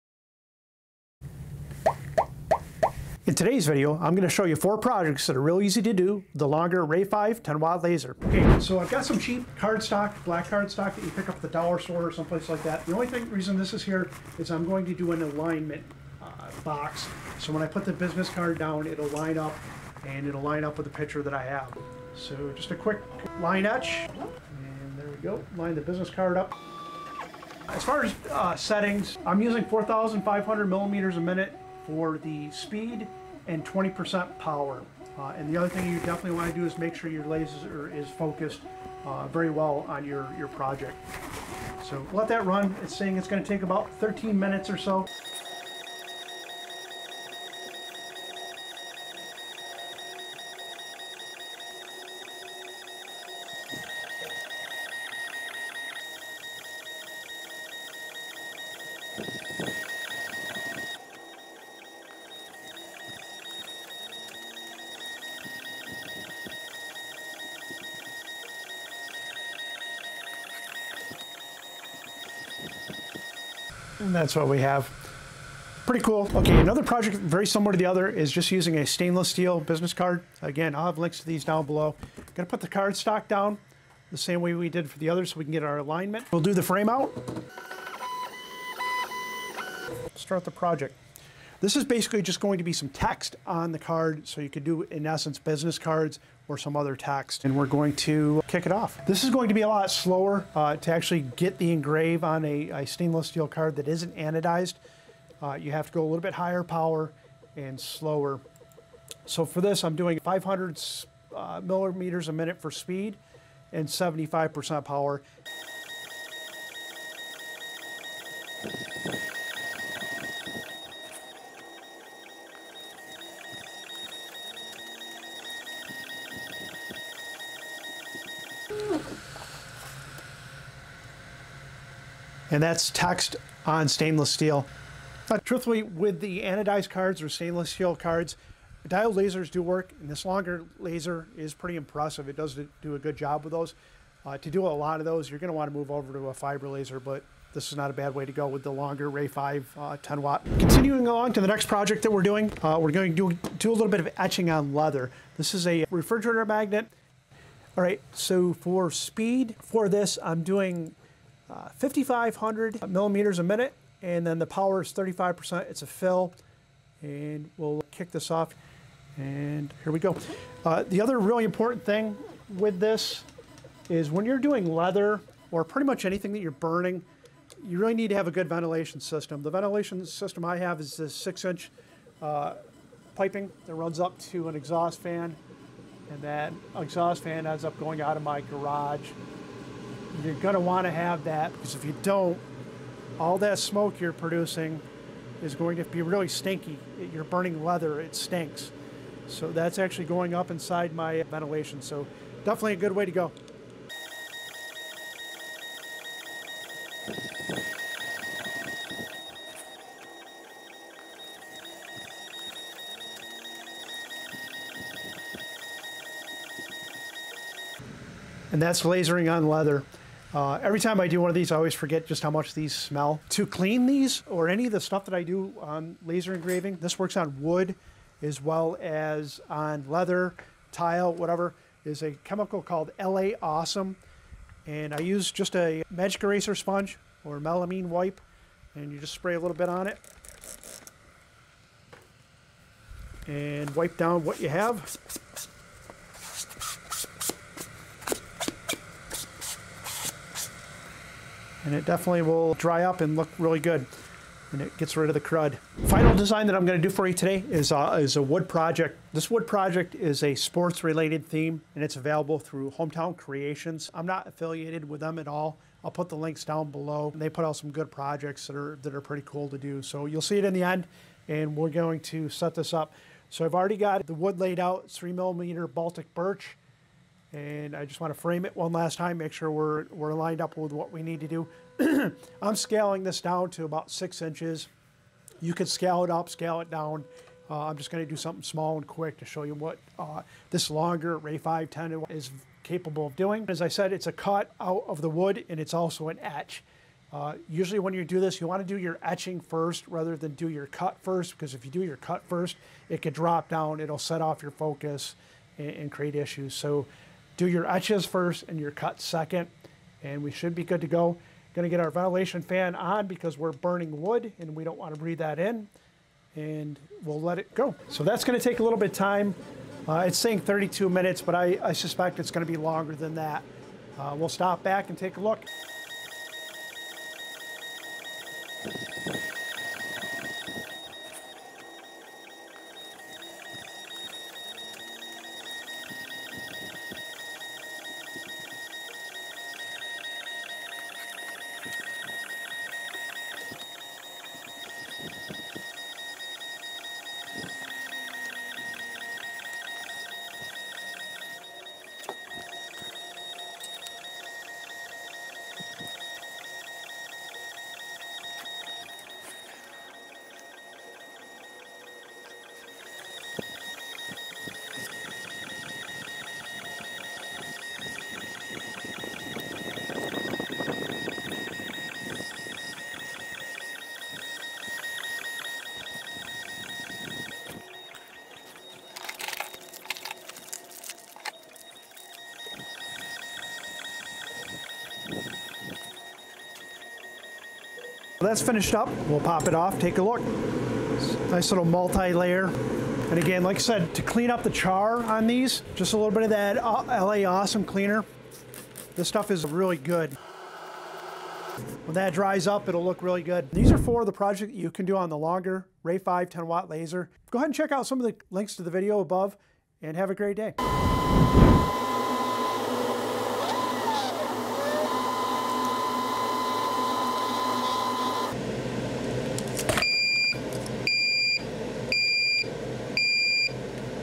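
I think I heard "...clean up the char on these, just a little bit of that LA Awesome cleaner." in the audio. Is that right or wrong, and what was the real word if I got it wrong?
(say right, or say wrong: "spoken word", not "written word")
right.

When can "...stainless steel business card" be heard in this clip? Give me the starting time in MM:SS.
01:18.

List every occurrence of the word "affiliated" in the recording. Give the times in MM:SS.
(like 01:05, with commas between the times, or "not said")
04:24.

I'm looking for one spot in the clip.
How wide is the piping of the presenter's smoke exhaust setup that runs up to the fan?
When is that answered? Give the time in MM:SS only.
03:01.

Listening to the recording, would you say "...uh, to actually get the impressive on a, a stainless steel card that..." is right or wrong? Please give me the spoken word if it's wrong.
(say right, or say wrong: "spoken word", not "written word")
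wrong: "engrave", not "impressive".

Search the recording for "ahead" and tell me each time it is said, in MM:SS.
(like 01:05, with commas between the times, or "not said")
06:47.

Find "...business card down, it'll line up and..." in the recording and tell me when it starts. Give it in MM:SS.
00:17.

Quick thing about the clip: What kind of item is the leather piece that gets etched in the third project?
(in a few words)
Refrigerator magnet.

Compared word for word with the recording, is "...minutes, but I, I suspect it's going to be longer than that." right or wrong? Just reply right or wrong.
right.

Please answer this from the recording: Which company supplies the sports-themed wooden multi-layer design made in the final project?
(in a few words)
Hometown Creations.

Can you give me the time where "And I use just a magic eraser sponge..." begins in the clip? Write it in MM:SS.
03:54.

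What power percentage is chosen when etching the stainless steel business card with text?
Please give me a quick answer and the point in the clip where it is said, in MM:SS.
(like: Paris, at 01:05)
75%, at 01:53.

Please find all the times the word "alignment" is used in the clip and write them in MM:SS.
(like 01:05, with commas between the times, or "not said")
00:15, 01:25.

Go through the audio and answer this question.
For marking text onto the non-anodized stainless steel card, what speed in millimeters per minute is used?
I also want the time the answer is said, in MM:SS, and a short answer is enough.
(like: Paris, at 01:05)
500, at 01:50.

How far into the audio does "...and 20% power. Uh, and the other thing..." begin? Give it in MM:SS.
00:33.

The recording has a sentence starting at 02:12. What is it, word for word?
and that's text on stainless steel.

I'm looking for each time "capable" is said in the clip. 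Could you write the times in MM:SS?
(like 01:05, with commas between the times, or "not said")
04:52.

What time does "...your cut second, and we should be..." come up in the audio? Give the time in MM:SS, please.
05:08.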